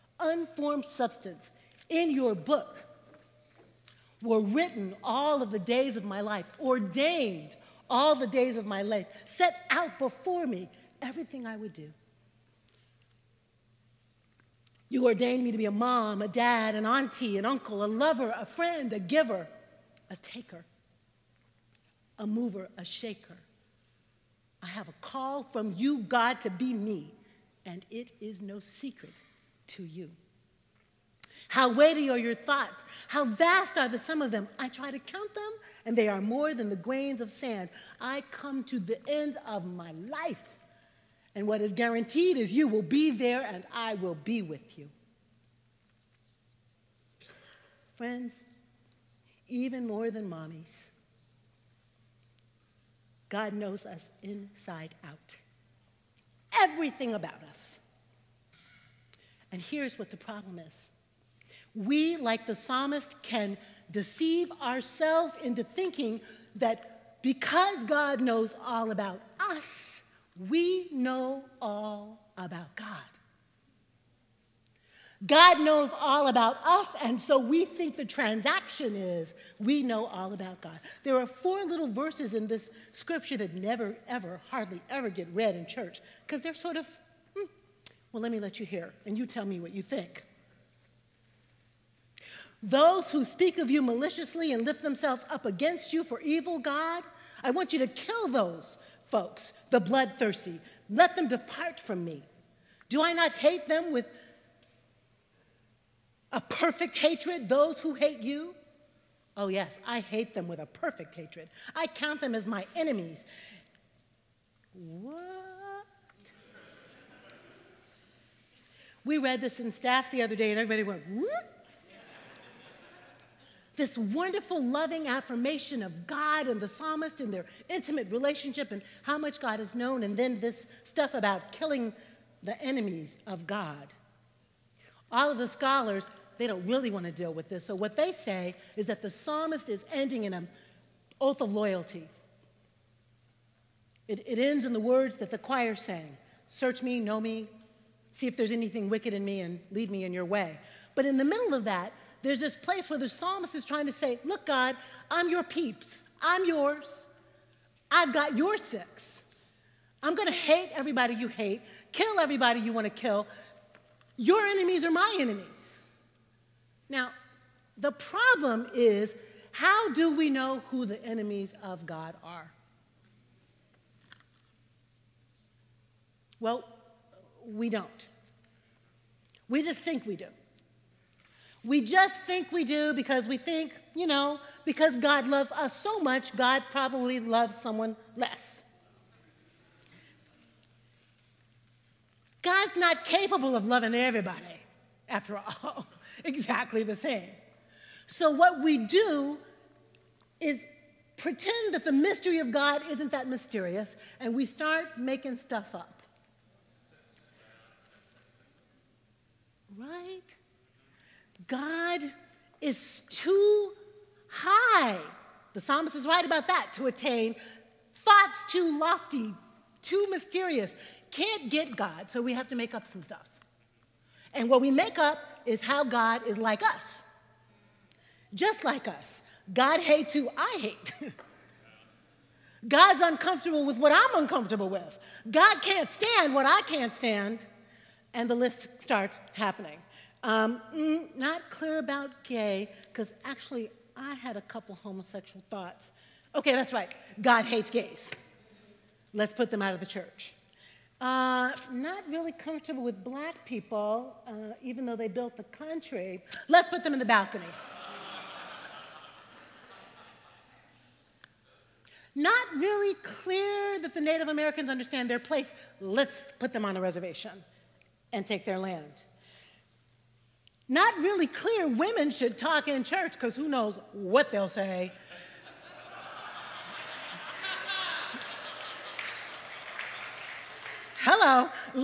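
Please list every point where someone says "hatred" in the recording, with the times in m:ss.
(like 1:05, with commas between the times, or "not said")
1:46, 1:51.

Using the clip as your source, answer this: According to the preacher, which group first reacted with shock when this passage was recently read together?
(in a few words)
staff.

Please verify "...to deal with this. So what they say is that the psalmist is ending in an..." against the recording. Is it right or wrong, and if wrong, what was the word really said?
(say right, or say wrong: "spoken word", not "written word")
right.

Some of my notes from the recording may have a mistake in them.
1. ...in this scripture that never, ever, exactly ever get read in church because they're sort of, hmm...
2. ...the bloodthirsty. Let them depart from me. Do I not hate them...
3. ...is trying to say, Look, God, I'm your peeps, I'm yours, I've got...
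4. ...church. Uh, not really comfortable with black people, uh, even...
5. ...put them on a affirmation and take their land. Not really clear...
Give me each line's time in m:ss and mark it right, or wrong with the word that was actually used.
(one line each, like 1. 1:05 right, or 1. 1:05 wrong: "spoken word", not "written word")
1. 1:22 wrong: "hardly", not "exactly"
2. 1:39 right
3. 2:33 right
4. 4:09 right
5. 4:26 wrong: "reservation", not "affirmation".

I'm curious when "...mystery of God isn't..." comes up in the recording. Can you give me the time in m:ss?
3:21.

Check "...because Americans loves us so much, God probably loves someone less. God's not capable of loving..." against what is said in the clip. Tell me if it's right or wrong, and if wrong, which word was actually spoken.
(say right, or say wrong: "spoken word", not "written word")
wrong: "God", not "Americans".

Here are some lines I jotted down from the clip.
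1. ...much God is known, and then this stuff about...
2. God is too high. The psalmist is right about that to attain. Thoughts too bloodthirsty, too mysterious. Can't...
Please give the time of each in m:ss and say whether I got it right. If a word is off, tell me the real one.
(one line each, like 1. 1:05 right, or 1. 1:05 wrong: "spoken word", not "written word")
1. 2:09 right
2. 3:31 wrong: "lofty", not "bloodthirsty".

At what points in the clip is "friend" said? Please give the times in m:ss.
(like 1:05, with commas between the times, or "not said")
0:18, 0:47.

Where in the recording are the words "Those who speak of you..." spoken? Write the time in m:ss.
1:32.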